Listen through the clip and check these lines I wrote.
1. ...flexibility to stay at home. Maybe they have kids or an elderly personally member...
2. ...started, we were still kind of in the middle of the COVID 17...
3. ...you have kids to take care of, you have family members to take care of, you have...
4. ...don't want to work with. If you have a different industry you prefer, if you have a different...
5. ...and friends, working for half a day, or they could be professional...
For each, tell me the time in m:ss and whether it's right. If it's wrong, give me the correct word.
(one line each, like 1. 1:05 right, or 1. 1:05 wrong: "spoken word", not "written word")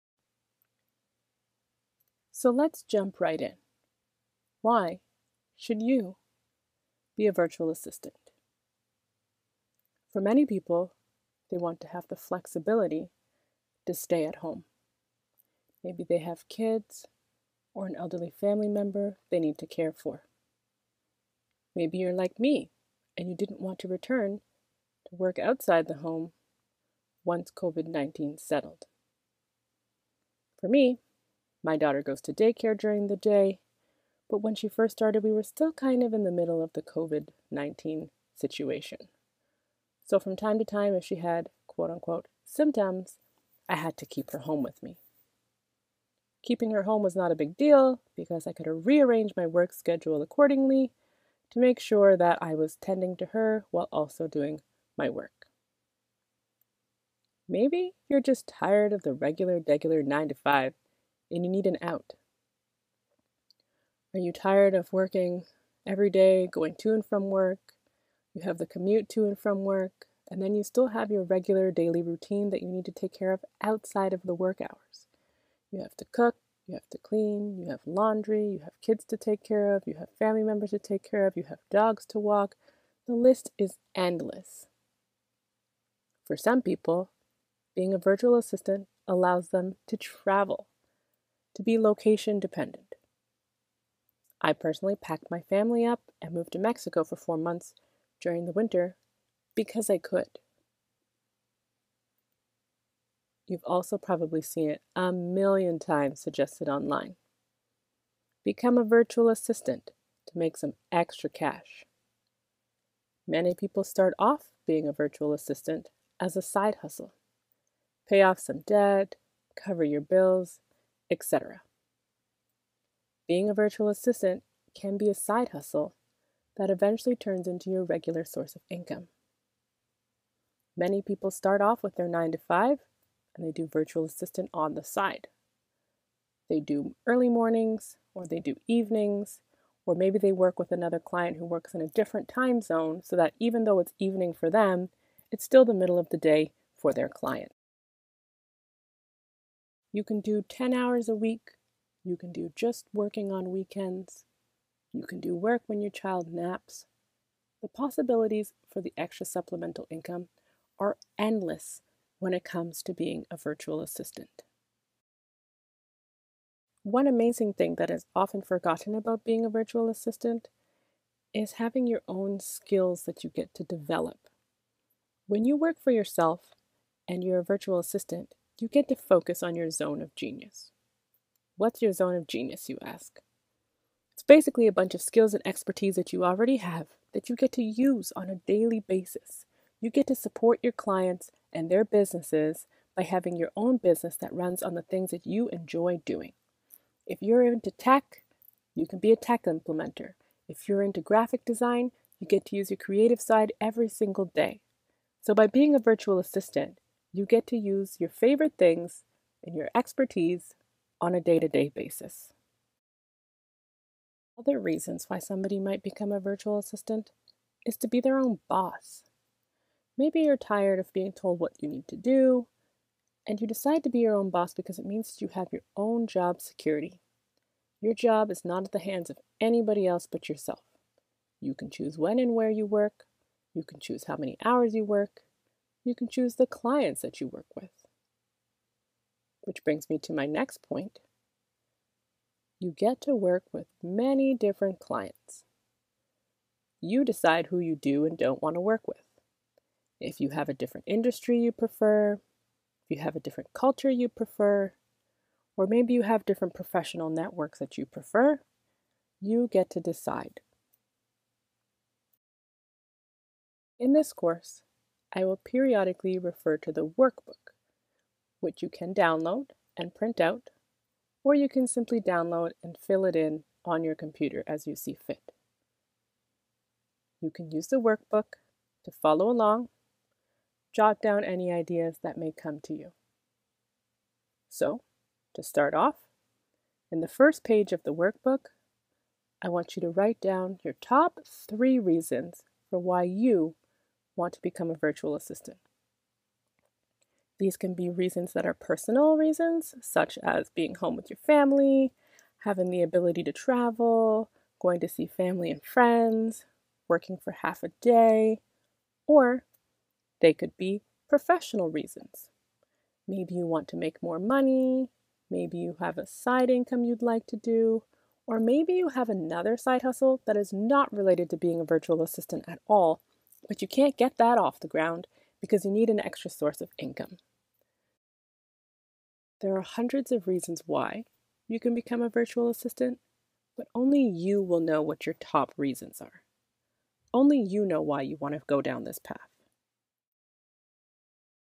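1. 0:12 wrong: "family", not "personally"
2. 0:34 wrong: "19", not "17"
3. 1:18 right
4. 4:08 right
5. 5:05 right.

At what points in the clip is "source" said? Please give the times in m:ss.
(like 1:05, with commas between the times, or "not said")
2:08, 5:26.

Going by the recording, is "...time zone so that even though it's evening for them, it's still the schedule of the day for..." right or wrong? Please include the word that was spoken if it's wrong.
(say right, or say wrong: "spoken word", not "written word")
wrong: "middle", not "schedule".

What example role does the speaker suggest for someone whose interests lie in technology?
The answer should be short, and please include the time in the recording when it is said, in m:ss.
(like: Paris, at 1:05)
tech implementer, at 3:19.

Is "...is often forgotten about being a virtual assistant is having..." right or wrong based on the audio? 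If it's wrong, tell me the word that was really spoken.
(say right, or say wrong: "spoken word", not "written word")
right.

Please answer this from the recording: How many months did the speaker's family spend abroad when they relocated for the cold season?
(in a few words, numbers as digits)
4.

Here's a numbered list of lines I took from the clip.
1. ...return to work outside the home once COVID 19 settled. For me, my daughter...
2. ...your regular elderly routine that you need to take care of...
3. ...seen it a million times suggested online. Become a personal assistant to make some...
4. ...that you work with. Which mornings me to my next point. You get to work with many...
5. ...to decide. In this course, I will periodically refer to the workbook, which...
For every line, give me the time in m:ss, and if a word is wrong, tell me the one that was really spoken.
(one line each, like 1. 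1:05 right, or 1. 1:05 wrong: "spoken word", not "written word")
1. 0:23 right
2. 1:11 wrong: "daily", not "elderly"
3. 1:44 wrong: "virtual", not "personal"
4. 3:57 wrong: "brings", not "mornings"
5. 4:19 right.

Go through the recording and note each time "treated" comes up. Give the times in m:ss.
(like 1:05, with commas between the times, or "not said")
not said.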